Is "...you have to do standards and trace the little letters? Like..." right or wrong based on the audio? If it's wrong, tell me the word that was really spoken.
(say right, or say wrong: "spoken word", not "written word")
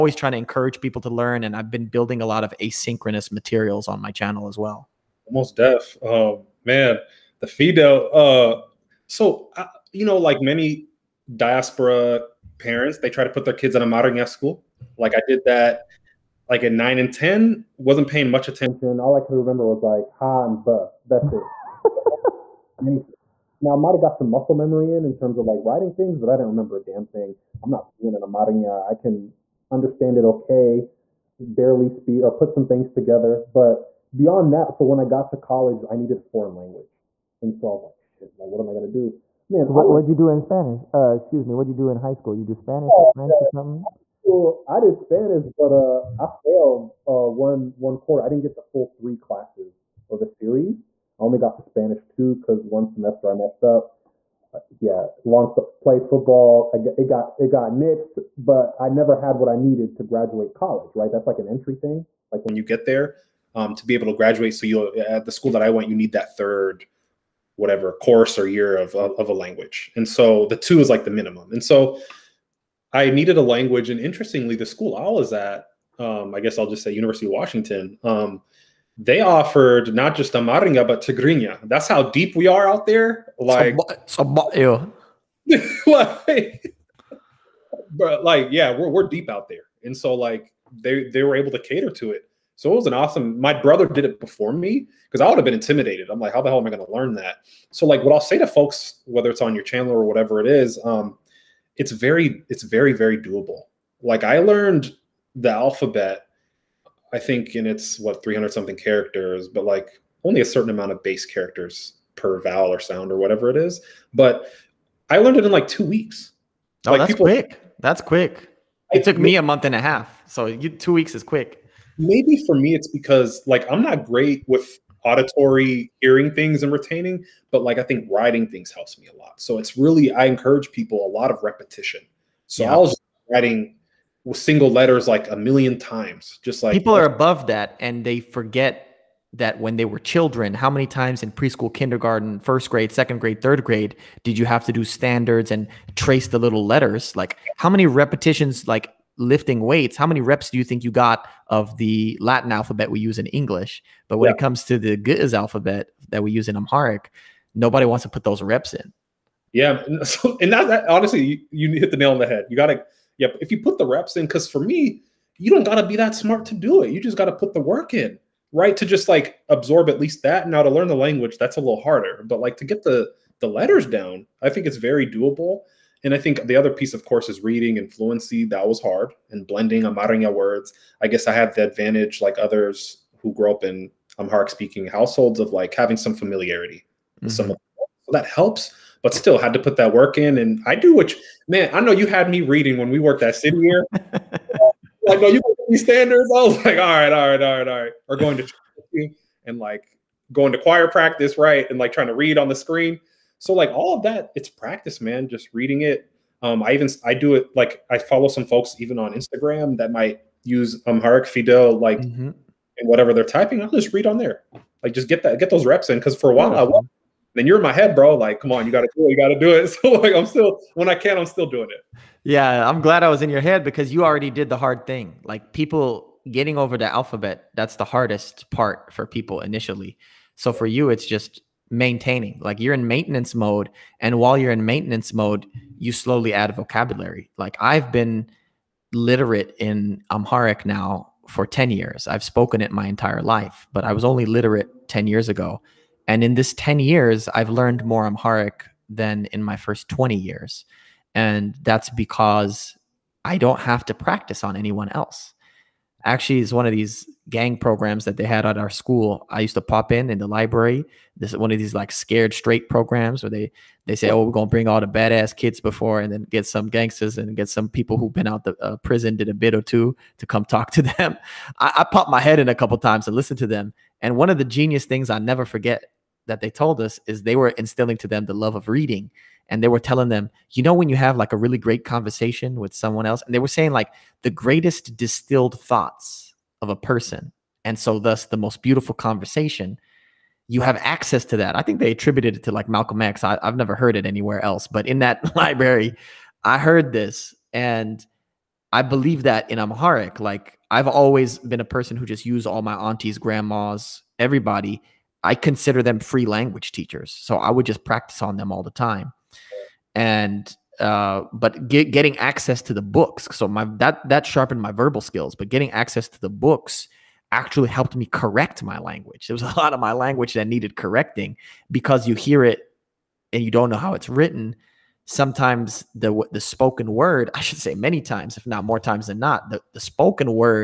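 right.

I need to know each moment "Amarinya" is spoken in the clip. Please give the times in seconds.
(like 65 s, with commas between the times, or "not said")
80 s.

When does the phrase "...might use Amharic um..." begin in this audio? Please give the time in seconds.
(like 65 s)
209 s.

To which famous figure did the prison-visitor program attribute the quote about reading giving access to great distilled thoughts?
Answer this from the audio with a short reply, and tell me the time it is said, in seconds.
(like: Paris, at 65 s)
Malcolm X, at 292 s.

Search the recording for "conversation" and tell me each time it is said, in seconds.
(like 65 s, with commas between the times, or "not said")
281 s, 288 s.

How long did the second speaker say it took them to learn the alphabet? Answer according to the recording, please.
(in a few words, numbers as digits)
a month and a half.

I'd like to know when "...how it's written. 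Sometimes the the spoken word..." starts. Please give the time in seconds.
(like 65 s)
323 s.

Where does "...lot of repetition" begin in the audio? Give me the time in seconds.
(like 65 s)
131 s.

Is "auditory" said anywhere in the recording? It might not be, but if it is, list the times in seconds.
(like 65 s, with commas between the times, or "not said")
125 s.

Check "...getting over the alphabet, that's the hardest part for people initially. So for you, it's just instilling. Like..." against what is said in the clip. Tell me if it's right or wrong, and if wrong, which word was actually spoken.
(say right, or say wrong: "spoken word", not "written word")
wrong: "maintaining", not "instilling".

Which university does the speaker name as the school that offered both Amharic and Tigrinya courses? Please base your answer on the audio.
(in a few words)
University of Washington.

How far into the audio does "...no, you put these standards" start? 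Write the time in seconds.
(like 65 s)
195 s.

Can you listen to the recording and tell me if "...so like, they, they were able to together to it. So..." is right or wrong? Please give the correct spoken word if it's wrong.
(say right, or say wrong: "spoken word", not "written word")
wrong: "cater", not "together".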